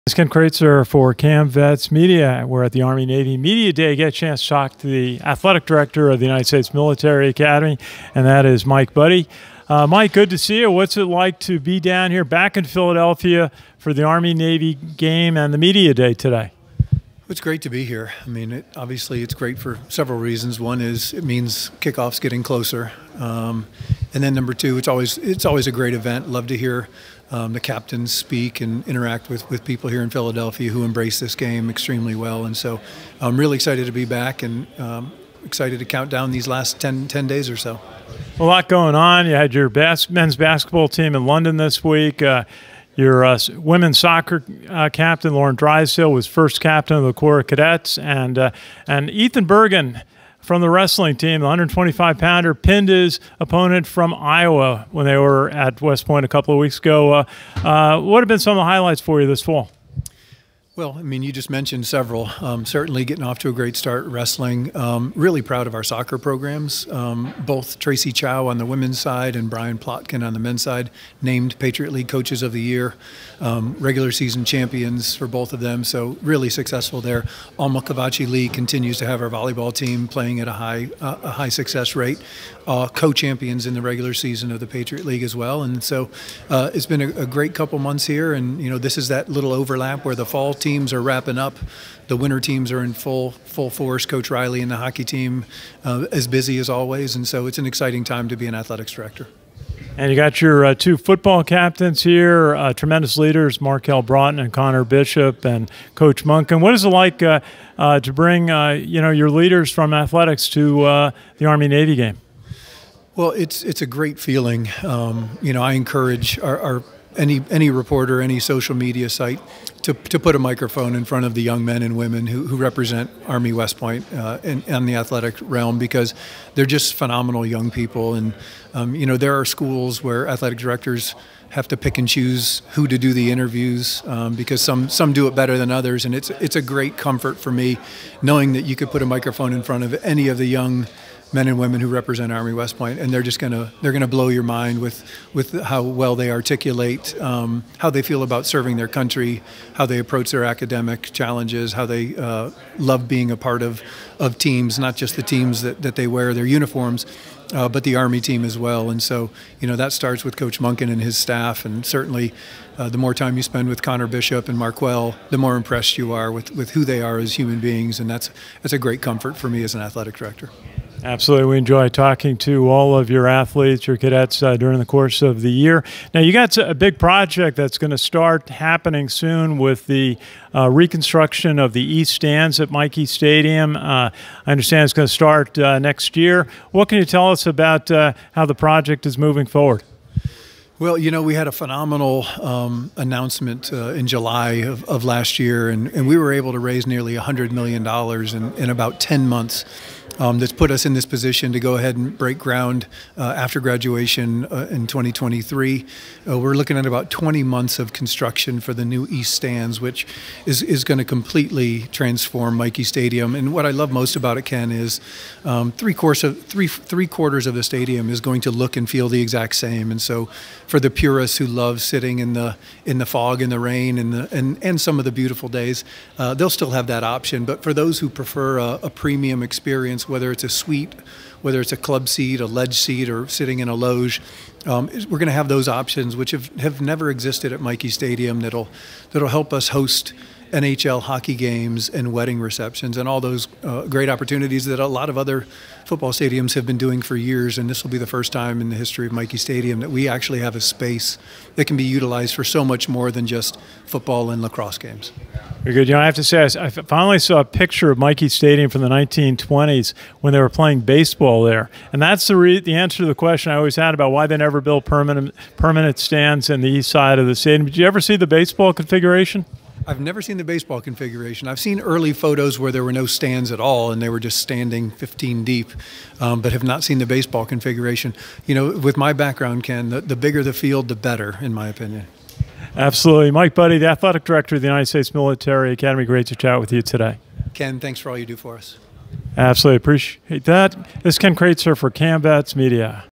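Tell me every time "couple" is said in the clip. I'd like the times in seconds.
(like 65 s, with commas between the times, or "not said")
56 s, 87 s.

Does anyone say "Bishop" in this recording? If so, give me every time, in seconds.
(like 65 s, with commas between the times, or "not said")
104 s, 164 s.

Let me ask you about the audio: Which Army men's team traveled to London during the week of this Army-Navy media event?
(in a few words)
Men's basketball.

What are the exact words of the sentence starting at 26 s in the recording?
Love to hear um, the captains speak and interact with, with people here in Philadelphia who embrace this game extremely well.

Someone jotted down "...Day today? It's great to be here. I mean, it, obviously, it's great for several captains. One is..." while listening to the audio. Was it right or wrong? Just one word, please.
wrong.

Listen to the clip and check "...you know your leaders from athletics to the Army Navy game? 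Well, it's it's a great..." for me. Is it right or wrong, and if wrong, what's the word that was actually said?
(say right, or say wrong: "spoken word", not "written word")
right.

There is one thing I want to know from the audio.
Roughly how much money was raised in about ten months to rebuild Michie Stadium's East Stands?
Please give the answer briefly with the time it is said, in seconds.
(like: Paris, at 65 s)
$100 million, at 197 s.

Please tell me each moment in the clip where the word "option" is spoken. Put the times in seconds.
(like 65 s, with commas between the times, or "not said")
227 s, 235 s.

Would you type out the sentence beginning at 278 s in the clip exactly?
You know, with my background, Ken, the, the bigger the field, the better, in my opinion.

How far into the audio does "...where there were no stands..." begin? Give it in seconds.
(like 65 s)
272 s.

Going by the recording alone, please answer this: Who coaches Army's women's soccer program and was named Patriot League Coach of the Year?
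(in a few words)
Tracey Chao.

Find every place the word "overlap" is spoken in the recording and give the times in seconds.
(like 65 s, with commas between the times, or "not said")
89 s.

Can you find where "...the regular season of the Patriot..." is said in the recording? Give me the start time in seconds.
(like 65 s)
83 s.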